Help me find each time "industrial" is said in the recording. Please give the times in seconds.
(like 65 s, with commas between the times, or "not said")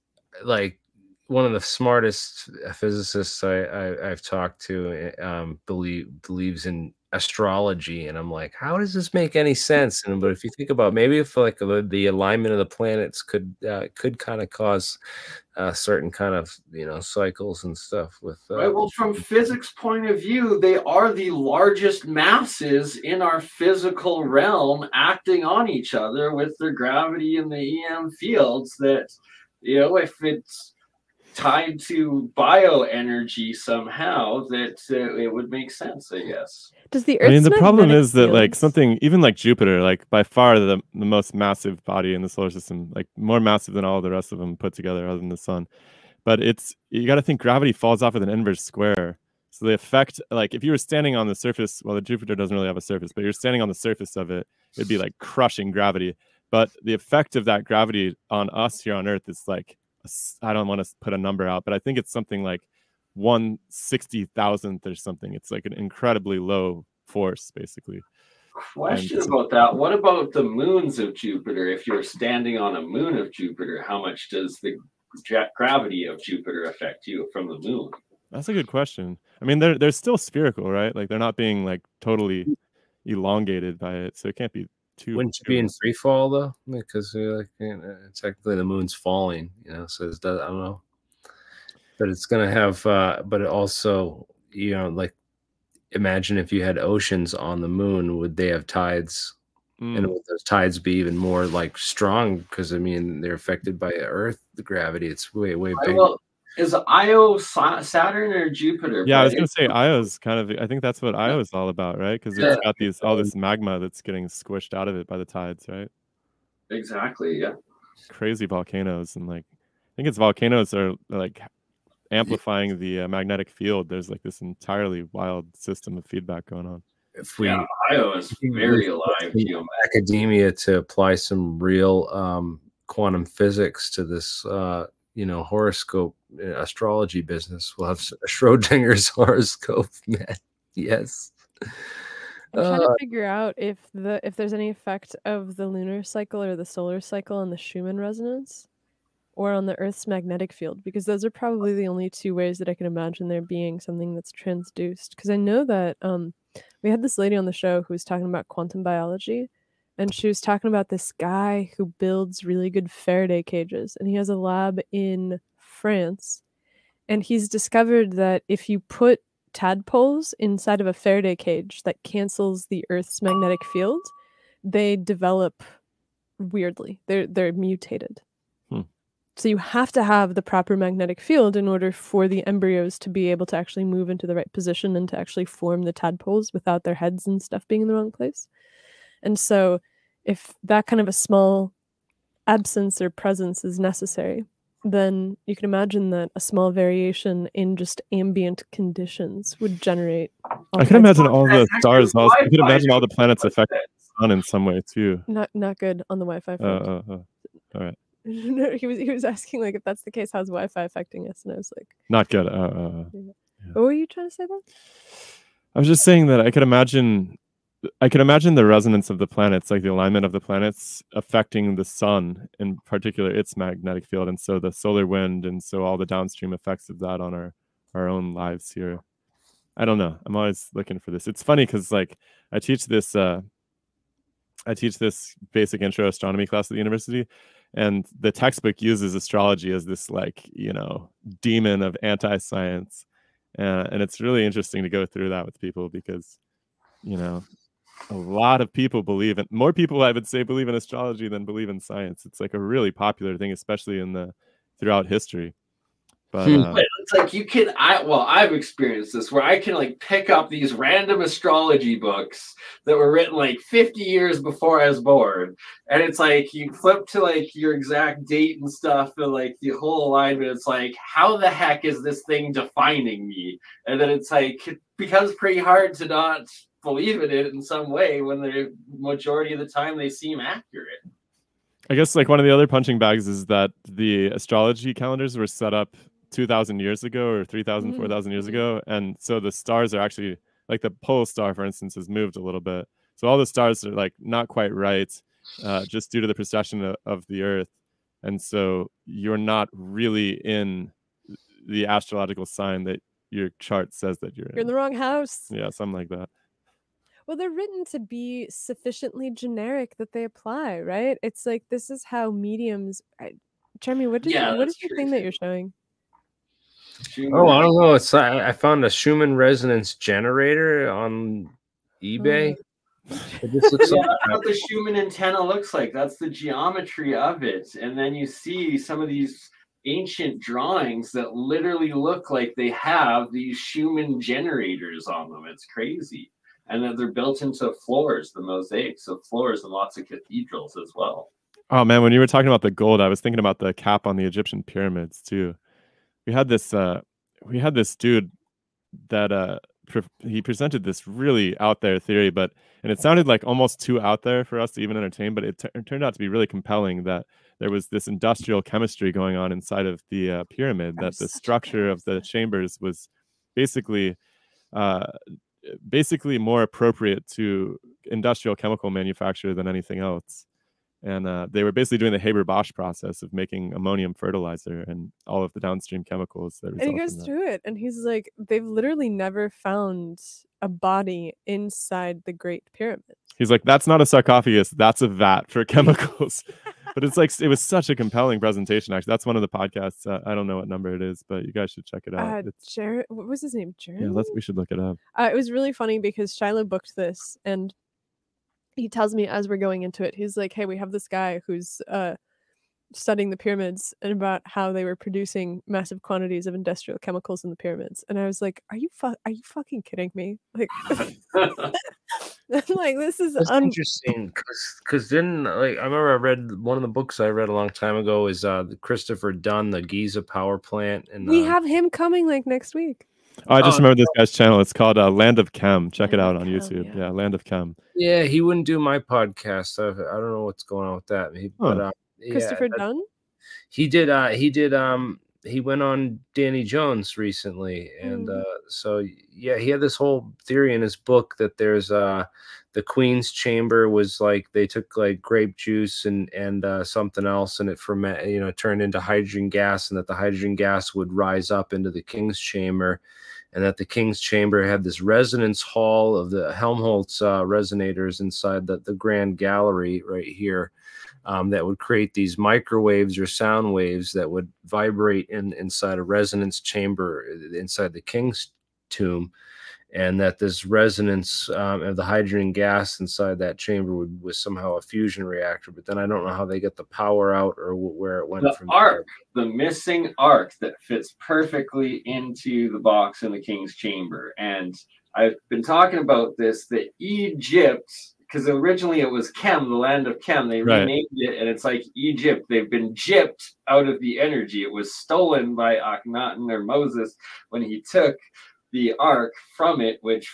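358 s, 368 s, 406 s.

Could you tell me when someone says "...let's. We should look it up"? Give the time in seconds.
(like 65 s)
394 s.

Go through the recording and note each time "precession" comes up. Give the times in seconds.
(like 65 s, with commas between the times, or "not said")
296 s.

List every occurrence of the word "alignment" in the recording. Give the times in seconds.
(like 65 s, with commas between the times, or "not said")
12 s, 219 s, 270 s.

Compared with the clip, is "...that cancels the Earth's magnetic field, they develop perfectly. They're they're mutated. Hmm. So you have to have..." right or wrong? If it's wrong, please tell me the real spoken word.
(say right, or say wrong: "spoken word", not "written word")
wrong: "weirdly", not "perfectly".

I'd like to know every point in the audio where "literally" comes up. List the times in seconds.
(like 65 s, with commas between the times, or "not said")
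331 s, 378 s.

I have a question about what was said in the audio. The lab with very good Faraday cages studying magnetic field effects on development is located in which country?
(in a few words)
France.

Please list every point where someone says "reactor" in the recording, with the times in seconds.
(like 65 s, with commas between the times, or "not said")
475 s.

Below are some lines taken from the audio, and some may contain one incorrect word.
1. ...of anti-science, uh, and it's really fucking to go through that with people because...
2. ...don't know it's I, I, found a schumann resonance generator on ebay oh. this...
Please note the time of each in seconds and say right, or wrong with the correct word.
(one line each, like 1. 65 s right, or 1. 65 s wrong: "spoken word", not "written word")
1. 241 s wrong: "interesting", not "fucking"
2. 317 s right.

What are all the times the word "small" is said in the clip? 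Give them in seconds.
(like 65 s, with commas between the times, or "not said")
191 s, 196 s.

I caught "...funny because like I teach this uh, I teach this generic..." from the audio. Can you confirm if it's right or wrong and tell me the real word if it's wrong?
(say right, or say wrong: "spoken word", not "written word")
wrong: "basic", not "generic".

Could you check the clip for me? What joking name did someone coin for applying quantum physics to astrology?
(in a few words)
Schrodinger's horoscope.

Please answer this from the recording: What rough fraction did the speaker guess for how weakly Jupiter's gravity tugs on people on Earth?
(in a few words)
1/60,000.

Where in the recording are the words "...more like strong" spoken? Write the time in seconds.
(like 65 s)
101 s.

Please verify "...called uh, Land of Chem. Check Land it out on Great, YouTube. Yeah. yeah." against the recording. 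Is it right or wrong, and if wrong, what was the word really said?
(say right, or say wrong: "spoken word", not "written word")
wrong: "Chem", not "Great".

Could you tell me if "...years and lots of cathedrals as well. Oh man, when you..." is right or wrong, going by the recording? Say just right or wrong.
wrong.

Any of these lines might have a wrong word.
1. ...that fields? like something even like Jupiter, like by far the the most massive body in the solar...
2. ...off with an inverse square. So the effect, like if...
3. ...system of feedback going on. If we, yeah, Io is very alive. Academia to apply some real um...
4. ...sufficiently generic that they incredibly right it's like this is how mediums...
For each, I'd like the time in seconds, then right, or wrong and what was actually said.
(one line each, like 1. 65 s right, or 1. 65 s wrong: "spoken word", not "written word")
1. 38 s right
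2. 48 s right
3. 125 s right
4. 308 s wrong: "apply", not "incredibly".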